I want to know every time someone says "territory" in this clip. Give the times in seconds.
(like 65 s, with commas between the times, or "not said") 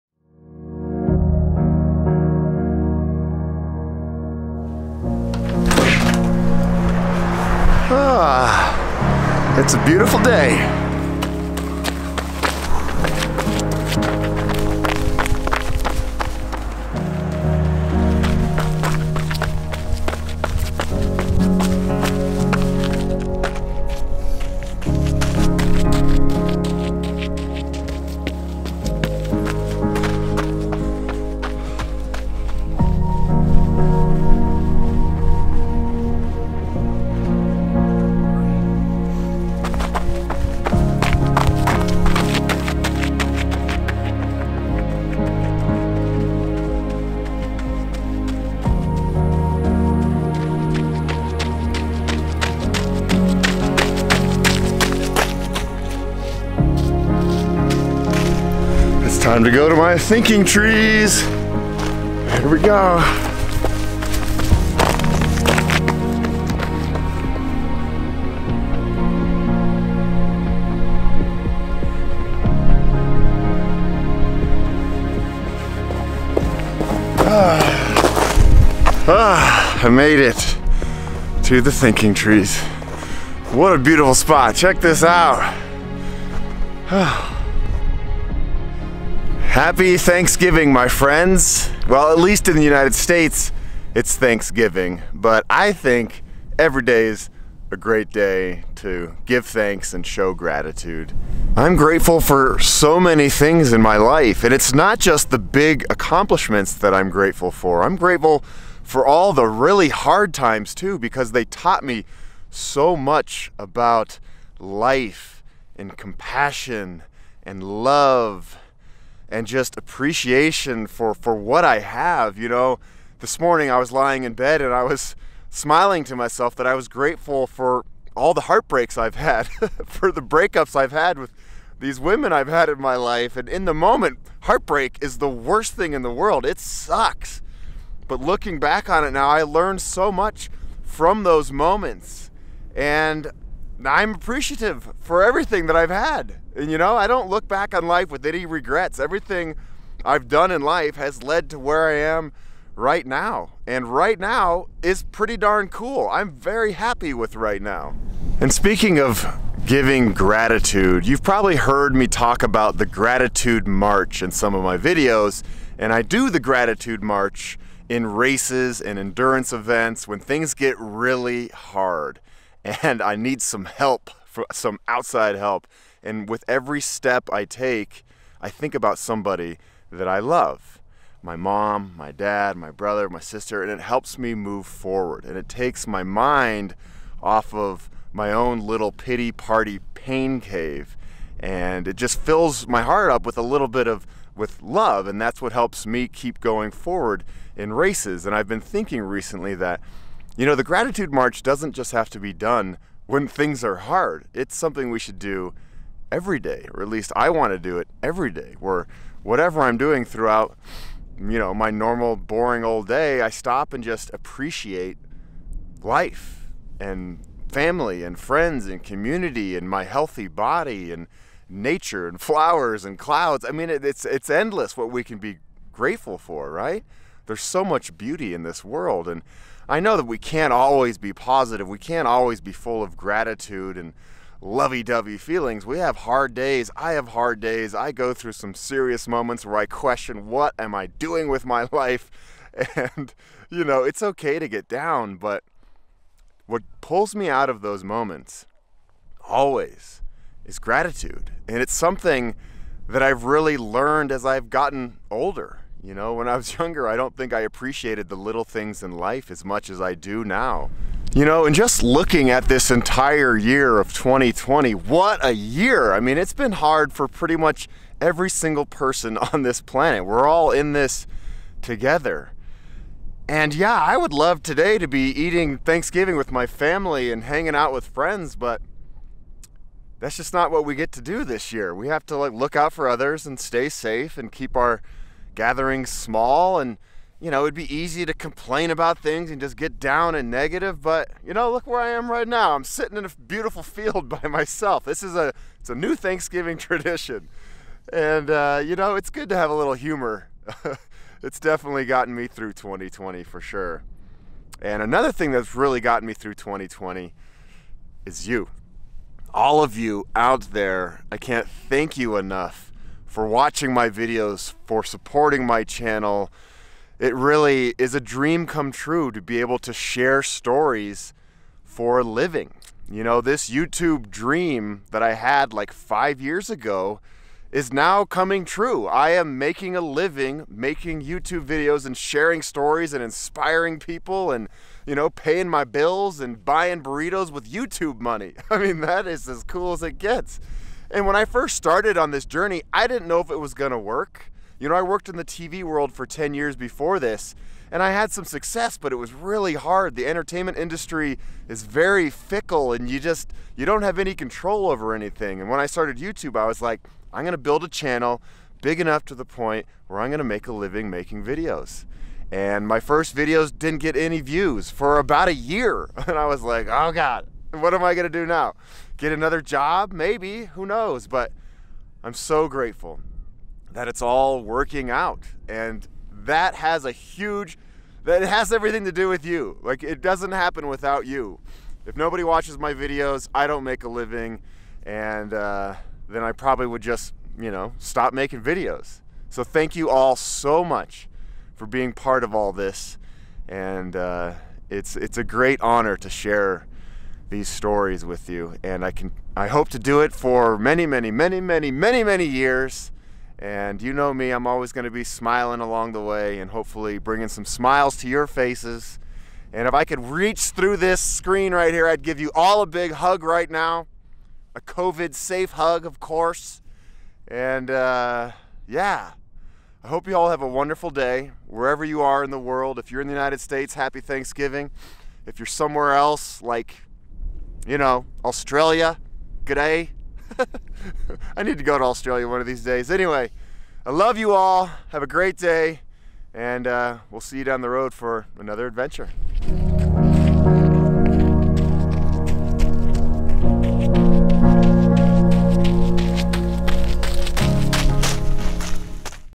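not said.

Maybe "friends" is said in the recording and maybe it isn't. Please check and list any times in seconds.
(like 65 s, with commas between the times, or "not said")
90 s, 218 s, 277 s.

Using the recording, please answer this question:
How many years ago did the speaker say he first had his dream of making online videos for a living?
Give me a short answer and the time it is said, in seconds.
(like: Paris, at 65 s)
5, at 325 s.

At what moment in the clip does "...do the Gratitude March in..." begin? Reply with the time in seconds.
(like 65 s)
166 s.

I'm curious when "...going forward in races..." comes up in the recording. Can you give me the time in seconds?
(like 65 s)
196 s.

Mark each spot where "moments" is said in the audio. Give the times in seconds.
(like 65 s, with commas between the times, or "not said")
133 s, 141 s, 239 s, 247 s.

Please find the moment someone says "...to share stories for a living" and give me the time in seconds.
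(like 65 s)
319 s.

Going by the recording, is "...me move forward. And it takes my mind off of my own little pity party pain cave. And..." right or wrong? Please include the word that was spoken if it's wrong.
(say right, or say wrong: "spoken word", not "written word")
right.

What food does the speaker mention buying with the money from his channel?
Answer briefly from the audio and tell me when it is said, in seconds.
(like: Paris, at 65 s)
burritos, at 336 s.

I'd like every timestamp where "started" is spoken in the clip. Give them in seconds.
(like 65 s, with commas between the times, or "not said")
341 s, 355 s.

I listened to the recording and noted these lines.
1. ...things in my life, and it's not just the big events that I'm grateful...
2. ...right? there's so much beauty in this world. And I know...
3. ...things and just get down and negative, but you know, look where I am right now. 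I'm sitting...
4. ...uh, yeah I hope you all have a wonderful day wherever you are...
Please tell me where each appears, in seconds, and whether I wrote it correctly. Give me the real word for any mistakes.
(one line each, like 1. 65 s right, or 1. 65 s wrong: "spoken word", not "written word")
1. 103 s wrong: "accomplishments", not "events"
2. 226 s right
3. 288 s right
4. 417 s right.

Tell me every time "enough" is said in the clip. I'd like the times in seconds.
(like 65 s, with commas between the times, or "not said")
312 s, 358 s.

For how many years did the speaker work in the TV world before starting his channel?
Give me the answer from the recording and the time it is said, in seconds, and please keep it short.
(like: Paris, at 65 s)
10, at 346 s.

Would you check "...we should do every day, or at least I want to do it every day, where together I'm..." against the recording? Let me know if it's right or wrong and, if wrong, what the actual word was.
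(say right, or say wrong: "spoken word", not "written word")
wrong: "whatever", not "together".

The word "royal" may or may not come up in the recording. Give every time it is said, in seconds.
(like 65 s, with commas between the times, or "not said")
not said.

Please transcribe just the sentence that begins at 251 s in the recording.
And it's something that I've really learned as I've gotten older.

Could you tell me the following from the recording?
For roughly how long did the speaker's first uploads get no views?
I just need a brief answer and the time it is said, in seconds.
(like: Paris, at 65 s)
about a year, at 364 s.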